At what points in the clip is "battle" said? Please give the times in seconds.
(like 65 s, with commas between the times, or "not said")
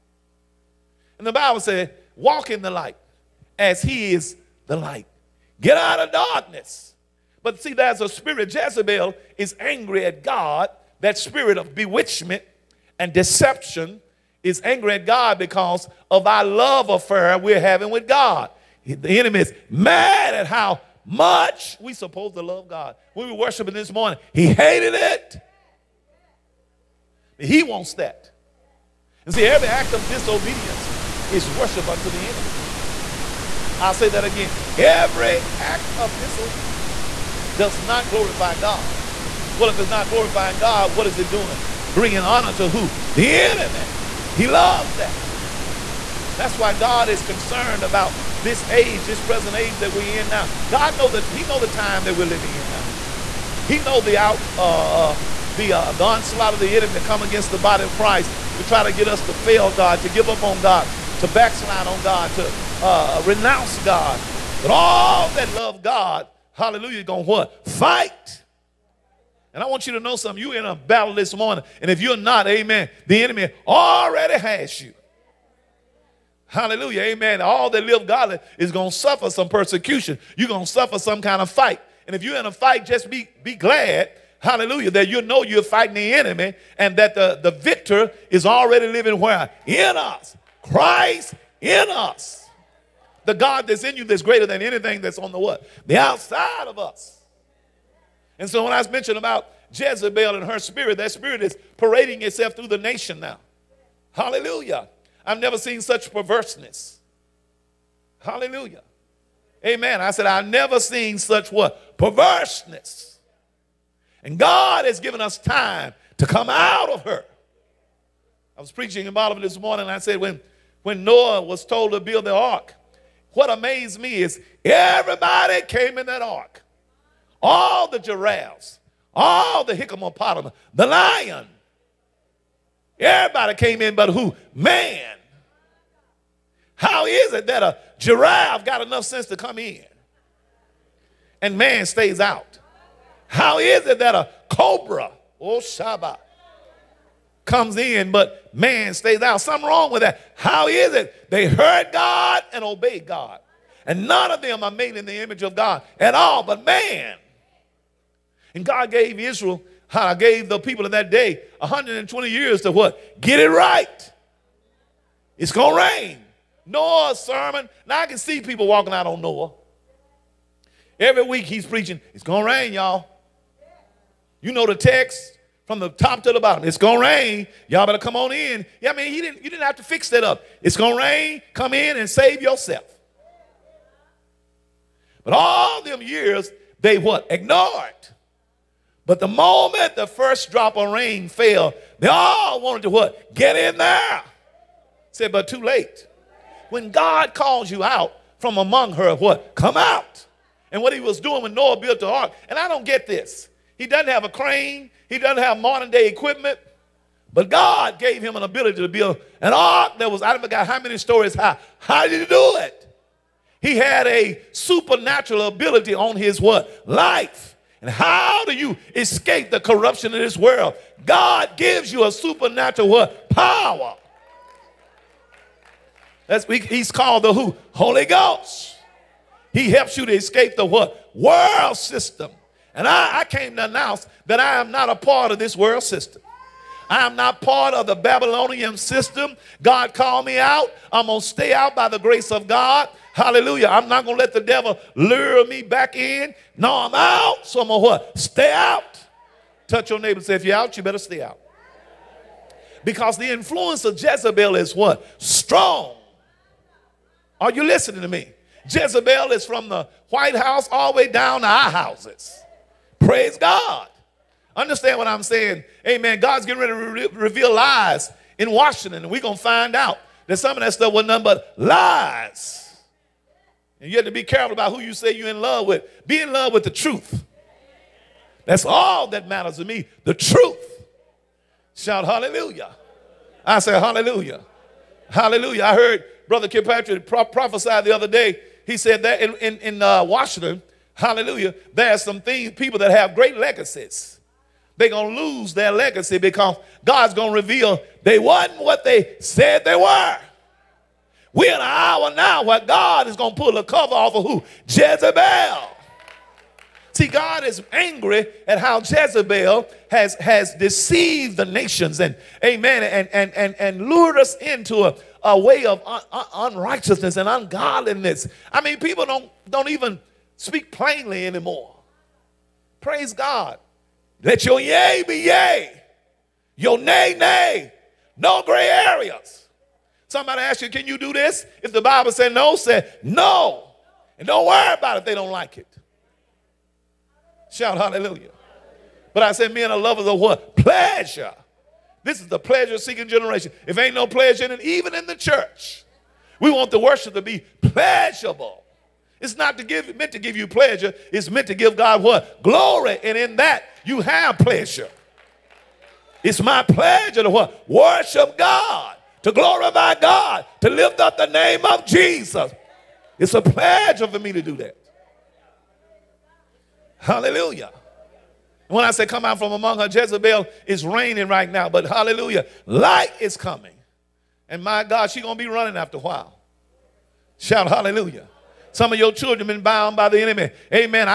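70 s.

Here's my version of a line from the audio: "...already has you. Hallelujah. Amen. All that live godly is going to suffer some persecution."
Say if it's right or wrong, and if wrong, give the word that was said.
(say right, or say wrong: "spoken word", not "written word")
right.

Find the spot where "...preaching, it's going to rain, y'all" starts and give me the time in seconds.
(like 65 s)
171 s.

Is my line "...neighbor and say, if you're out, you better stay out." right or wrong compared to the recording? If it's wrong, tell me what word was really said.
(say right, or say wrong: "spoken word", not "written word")
right.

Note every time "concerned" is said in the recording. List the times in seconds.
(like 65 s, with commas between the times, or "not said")
47 s.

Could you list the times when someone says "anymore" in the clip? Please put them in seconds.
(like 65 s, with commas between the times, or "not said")
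321 s.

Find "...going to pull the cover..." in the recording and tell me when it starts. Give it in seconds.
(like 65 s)
303 s.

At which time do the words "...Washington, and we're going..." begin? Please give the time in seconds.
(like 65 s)
268 s.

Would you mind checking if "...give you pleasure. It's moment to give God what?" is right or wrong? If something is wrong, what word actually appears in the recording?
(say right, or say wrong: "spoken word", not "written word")
wrong: "meant", not "moment".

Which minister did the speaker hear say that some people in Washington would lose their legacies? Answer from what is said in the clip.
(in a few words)
Brother Kilpatrick.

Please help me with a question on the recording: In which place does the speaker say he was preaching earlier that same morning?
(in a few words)
Oliver.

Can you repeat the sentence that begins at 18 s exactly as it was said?
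The enemy is mad at how much we supposed to love God.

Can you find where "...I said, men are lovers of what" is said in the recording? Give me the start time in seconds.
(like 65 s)
339 s.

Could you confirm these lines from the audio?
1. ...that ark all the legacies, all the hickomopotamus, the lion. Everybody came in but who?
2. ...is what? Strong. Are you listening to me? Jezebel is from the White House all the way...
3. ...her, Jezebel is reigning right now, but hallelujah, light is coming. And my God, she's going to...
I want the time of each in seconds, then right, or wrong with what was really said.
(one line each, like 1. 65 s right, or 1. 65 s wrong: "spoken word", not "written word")
1. 126 s wrong: "giraffes", not "legacies"
2. 254 s right
3. 369 s right.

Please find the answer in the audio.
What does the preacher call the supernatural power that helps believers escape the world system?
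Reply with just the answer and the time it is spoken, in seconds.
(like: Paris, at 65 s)
Holy Ghost, at 227 s.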